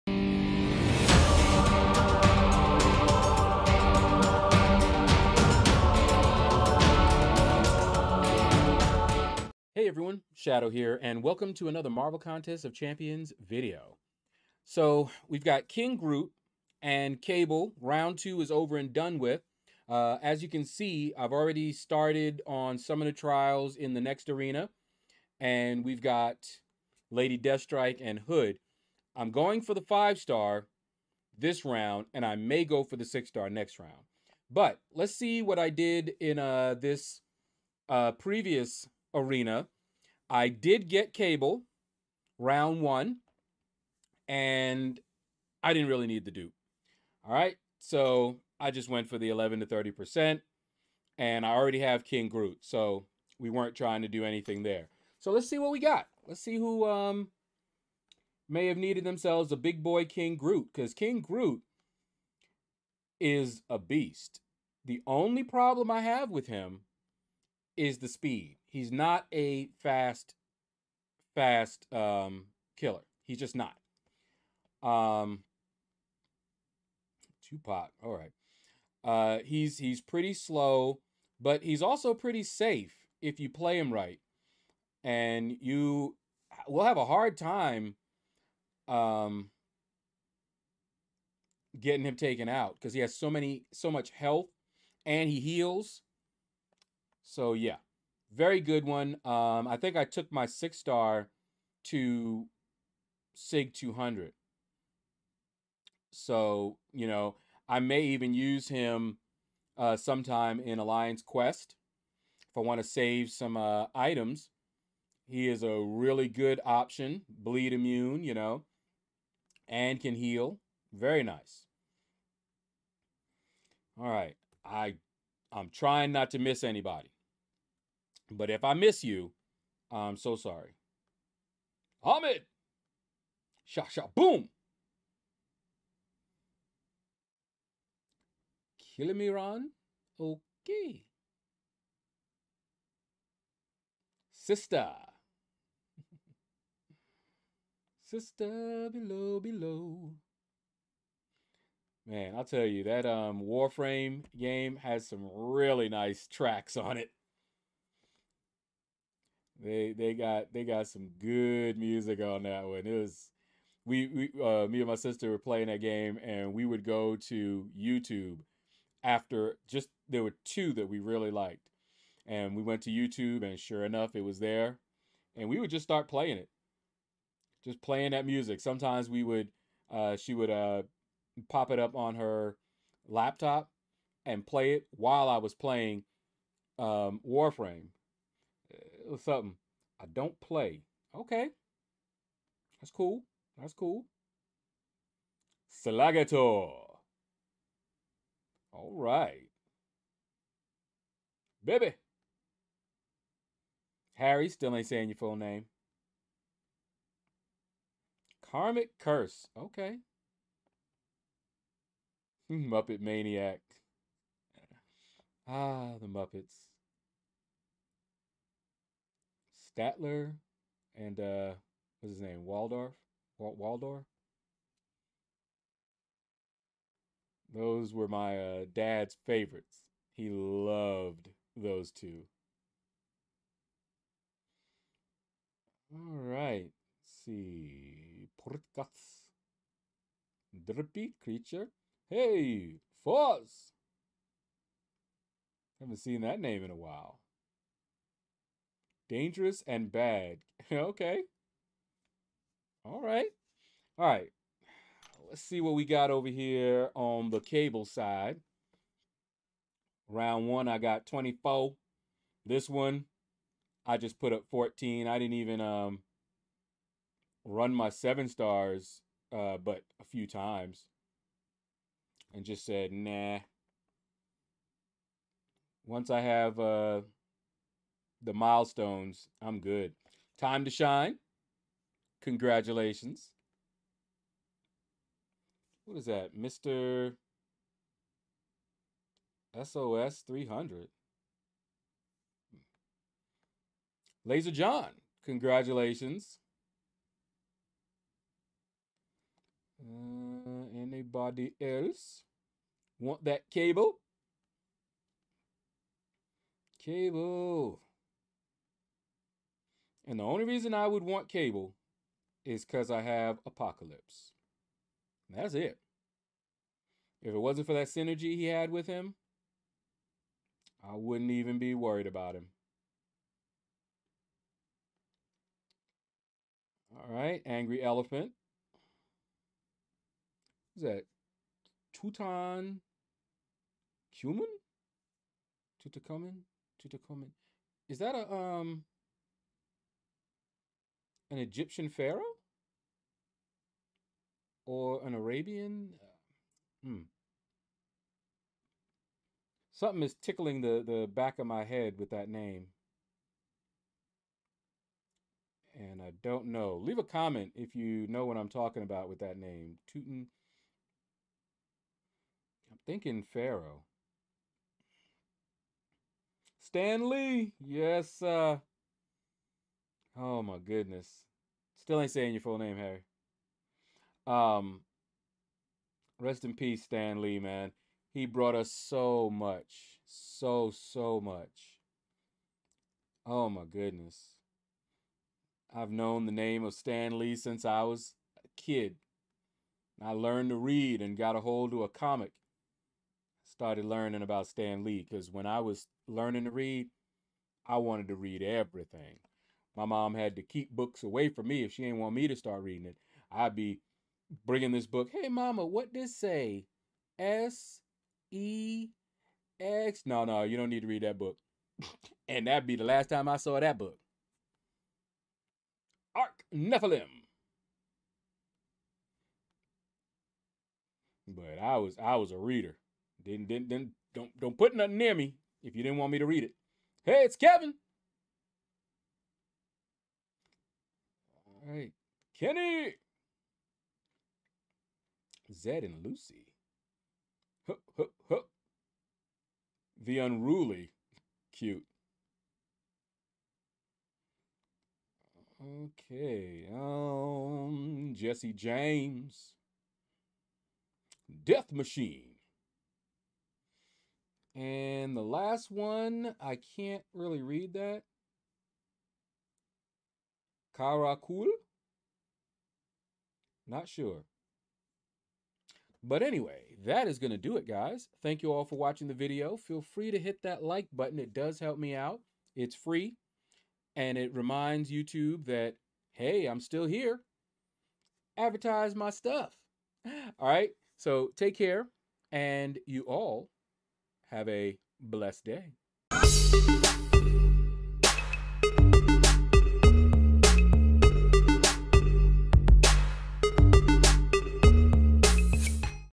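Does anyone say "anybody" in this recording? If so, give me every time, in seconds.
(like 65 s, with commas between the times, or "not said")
126 s, 300 s.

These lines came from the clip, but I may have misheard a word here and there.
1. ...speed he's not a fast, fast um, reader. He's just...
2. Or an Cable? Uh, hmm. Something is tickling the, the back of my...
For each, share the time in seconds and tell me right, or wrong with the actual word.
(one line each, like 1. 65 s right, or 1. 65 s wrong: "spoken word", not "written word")
1. 68 s wrong: "killer", not "reader"
2. 344 s wrong: "Arabian", not "Cable".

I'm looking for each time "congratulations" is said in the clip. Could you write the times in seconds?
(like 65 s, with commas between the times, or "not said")
282 s, 295 s.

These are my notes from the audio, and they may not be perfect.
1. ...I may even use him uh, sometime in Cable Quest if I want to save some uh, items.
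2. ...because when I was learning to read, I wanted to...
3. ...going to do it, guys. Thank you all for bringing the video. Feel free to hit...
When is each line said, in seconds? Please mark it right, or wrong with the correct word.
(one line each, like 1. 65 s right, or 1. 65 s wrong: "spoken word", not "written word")
1. 107 s wrong: "Alliance", not "Cable"
2. 395 s right
3. 467 s wrong: "watching", not "bringing".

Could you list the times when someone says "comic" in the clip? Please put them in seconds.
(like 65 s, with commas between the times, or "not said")
391 s.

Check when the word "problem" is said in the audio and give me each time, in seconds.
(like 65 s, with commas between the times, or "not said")
65 s.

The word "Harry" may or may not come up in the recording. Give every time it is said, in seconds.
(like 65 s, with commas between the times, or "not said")
204 s, 372 s.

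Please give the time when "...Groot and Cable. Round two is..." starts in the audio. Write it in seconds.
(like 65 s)
15 s.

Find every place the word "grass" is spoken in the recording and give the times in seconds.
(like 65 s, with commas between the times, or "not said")
not said.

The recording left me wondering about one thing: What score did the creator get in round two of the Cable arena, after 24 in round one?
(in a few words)
14.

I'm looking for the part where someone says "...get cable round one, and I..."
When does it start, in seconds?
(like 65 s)
40 s.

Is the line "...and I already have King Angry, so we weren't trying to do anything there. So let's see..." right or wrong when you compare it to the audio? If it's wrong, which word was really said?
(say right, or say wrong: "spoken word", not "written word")
wrong: "Groot", not "Angry".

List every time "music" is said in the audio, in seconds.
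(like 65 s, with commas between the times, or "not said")
161 s, 178 s.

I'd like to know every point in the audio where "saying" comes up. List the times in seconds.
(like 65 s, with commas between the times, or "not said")
204 s, 372 s.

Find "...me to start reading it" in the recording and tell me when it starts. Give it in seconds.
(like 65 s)
402 s.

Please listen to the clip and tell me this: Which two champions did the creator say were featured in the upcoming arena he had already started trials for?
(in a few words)
Lady Deathstrike and Hood.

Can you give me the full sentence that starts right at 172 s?
And we went to YouTube and sure enough it was there.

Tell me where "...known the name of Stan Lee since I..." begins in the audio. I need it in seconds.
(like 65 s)
385 s.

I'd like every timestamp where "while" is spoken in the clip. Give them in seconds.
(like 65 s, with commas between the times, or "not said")
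184 s, 246 s.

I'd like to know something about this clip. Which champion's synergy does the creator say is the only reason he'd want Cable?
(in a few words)
Apocalypse.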